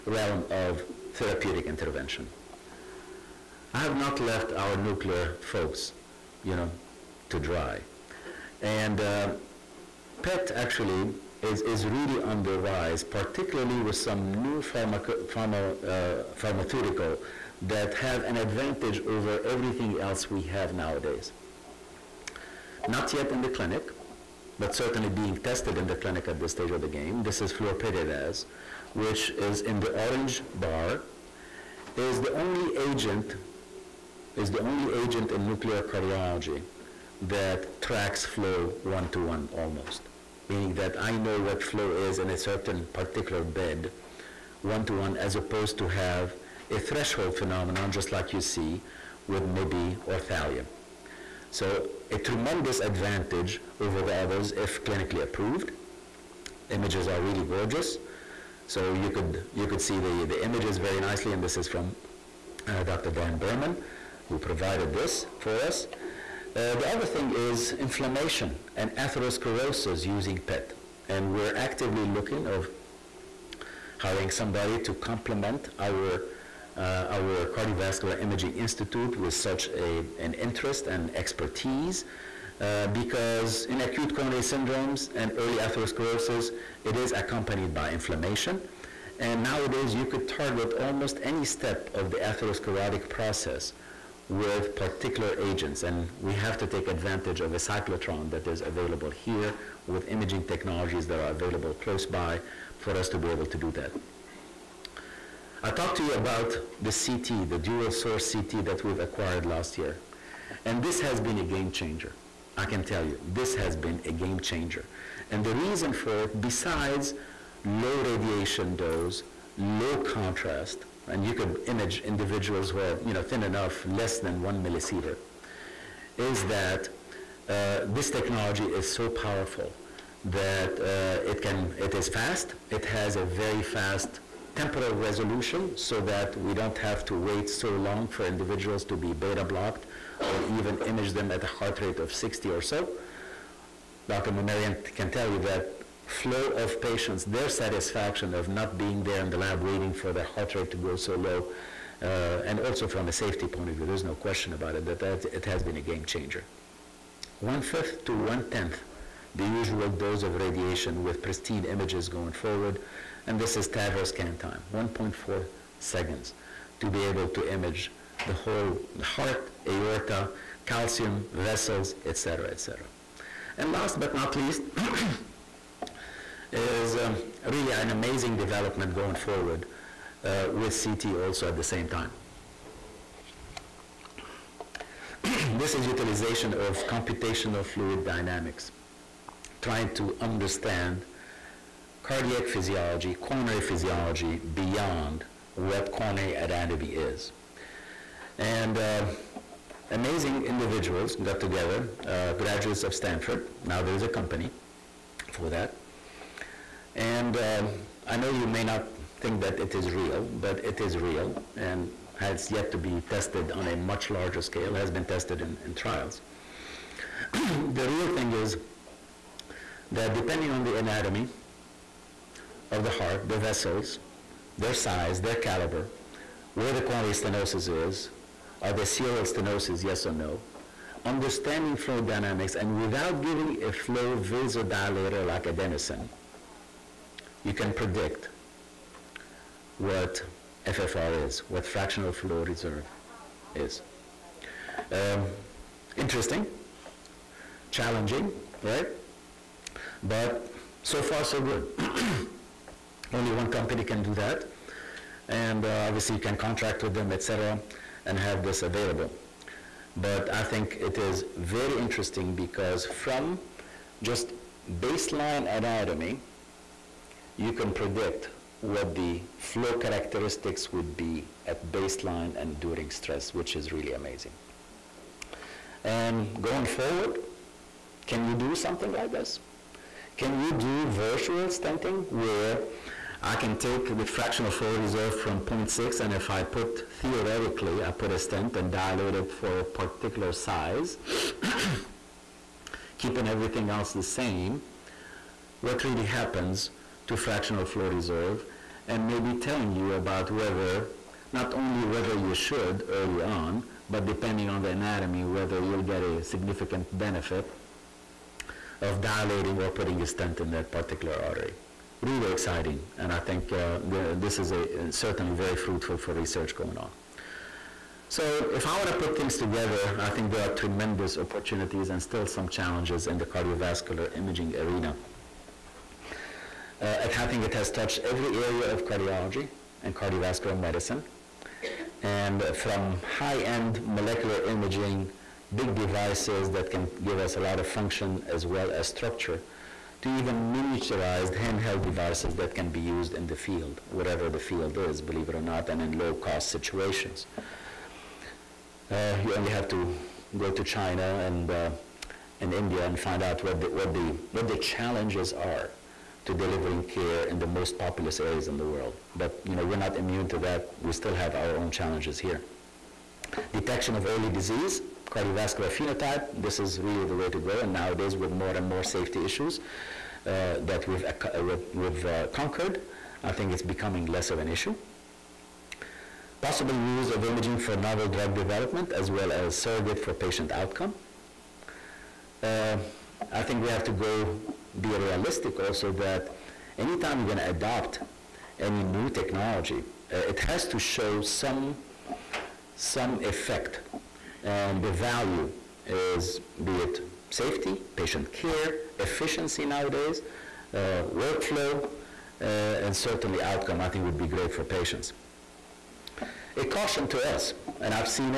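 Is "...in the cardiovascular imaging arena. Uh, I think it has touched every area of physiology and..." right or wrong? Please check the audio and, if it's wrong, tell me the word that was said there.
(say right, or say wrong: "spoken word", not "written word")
wrong: "cardiology", not "physiology".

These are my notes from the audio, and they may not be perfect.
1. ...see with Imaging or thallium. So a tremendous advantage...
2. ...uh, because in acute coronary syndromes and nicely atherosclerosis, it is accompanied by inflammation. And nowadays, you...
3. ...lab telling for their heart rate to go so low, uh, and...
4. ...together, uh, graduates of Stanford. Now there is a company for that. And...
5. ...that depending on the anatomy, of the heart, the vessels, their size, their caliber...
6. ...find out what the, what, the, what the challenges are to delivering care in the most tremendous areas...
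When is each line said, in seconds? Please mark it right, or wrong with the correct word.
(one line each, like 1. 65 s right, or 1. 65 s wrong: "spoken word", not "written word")
1. 48 s wrong: "MIBI", not "Imaging"
2. 82 s wrong: "early", not "nicely"
3. 149 s wrong: "waiting", not "telling"
4. 201 s right
5. 219 s right
6. 352 s wrong: "populous", not "tremendous".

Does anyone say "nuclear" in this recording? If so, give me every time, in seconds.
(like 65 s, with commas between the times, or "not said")
4 s, 35 s.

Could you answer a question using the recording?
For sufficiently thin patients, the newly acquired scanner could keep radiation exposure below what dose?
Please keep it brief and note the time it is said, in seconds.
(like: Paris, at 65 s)
1 millisievert, at 124 s.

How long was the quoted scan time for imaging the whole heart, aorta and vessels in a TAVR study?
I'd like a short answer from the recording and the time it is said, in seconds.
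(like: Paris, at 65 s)
1.4 seconds, at 164 s.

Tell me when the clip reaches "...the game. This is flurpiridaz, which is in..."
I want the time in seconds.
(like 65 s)
26 s.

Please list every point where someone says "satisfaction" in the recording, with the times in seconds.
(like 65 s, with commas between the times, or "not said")
147 s.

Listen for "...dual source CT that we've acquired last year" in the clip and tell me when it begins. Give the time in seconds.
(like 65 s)
107 s.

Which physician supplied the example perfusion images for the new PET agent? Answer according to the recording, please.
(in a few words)
Dan Berman.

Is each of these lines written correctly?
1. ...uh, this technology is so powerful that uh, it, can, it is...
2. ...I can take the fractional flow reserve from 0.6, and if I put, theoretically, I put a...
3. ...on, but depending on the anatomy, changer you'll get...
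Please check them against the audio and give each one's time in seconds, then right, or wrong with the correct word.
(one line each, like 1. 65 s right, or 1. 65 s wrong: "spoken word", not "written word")
1. 127 s right
2. 283 s right
3. 303 s wrong: "whether", not "changer".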